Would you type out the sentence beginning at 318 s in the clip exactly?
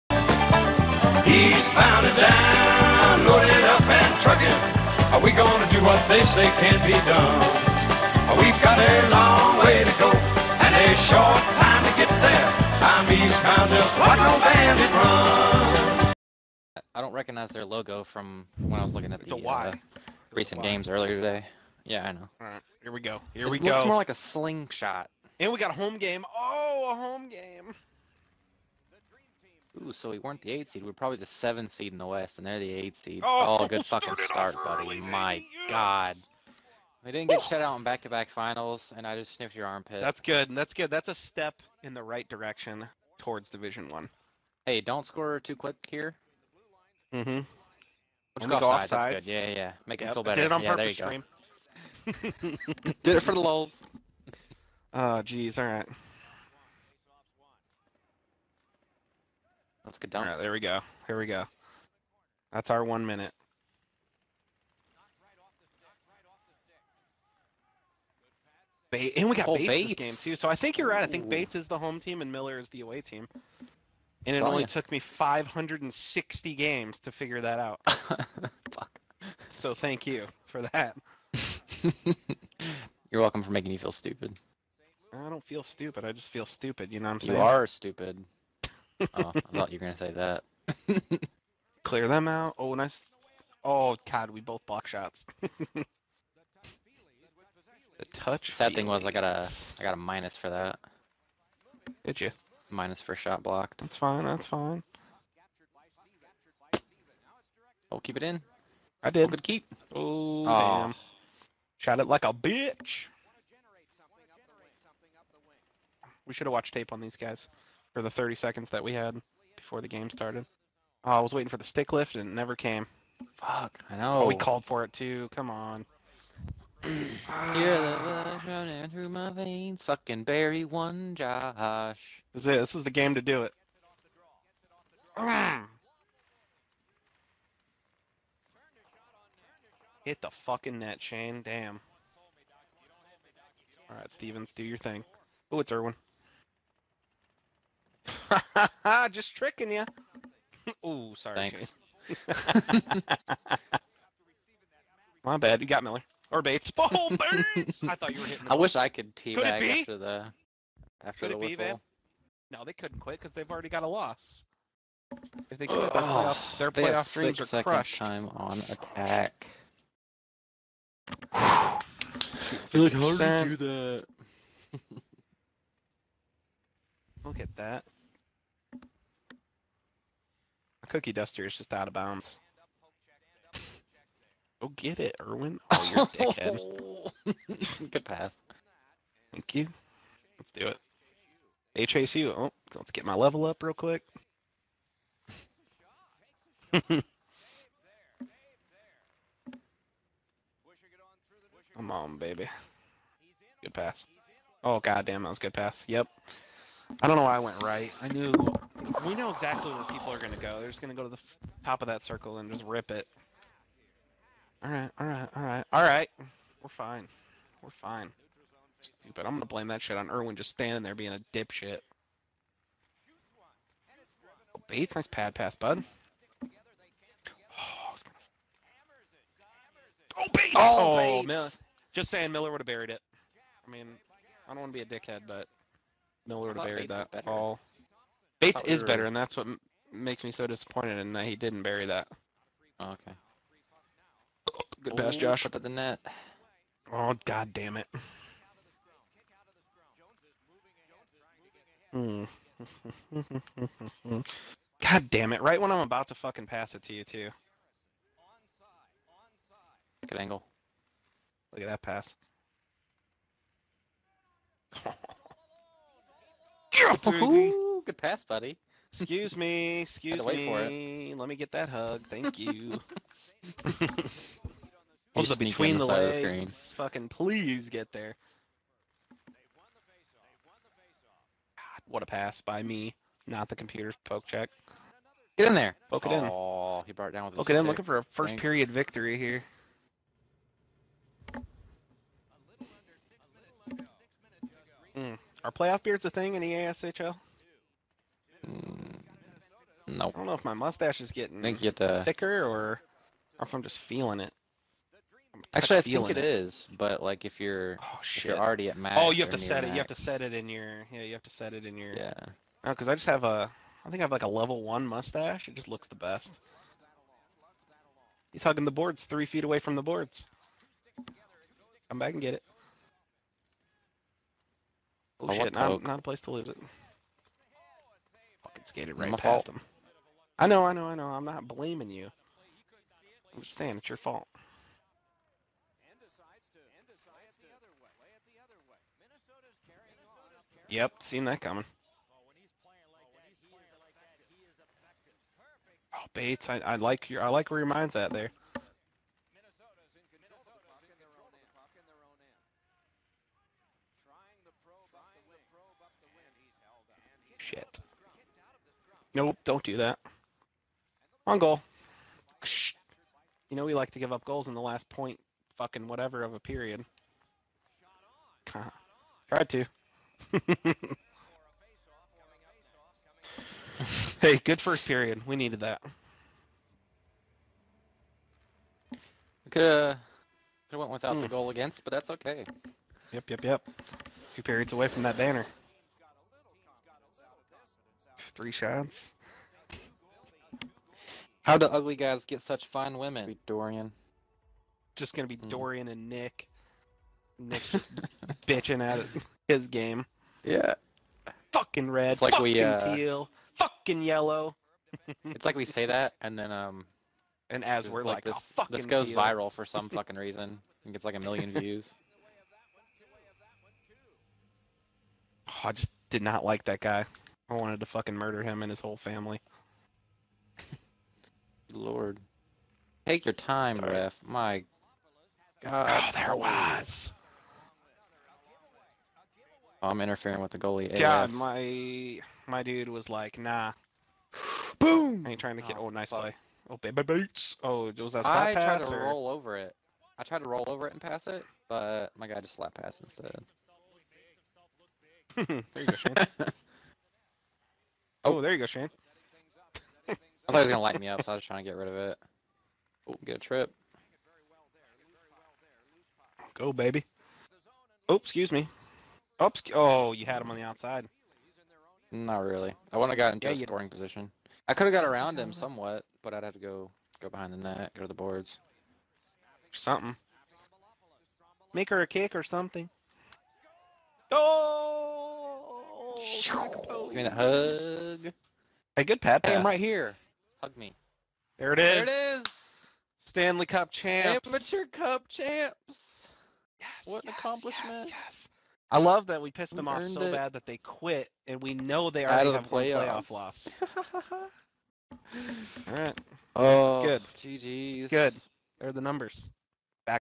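He's hugging the boards, three feet away from the boards.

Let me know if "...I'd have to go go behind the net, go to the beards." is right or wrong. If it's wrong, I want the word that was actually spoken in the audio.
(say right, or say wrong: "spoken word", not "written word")
wrong: "boards", not "beards".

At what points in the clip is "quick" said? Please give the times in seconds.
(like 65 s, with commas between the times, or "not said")
45 s, 193 s.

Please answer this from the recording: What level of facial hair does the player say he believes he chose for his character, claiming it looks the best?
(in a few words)
Level one.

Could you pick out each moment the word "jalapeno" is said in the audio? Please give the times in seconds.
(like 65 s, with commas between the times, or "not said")
not said.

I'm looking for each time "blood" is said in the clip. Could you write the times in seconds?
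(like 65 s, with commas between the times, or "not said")
128 s.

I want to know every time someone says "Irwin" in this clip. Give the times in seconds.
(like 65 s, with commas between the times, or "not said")
145 s, 220 s.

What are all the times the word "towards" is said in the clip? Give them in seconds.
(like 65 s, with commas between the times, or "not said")
43 s.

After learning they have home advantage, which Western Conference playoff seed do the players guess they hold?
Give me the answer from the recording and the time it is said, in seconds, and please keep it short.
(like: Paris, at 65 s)
7, at 31 s.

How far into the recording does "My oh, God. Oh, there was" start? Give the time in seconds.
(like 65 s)
424 s.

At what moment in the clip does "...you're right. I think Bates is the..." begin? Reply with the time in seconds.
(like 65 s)
70 s.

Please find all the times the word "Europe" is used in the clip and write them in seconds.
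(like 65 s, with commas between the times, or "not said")
not said.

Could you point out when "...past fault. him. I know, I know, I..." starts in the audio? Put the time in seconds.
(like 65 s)
329 s.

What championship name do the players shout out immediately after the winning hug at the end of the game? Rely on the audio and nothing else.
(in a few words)
Amateur Cup.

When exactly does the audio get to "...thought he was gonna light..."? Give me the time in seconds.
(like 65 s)
450 s.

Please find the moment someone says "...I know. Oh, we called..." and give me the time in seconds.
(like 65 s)
123 s.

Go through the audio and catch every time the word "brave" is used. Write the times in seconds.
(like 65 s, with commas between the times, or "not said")
not said.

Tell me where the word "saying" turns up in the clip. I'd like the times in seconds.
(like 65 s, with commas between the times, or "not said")
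87 s, 232 s, 333 s.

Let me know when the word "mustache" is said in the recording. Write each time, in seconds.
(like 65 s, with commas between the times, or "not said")
300 s, 314 s.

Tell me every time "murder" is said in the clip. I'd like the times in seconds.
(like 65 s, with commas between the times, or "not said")
418 s.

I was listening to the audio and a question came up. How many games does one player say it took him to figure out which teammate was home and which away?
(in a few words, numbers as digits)
560.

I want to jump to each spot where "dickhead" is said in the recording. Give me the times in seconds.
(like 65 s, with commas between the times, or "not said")
186 s, 234 s.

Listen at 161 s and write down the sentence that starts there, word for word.
Be, no, they couldn't quit because they've already got a loss.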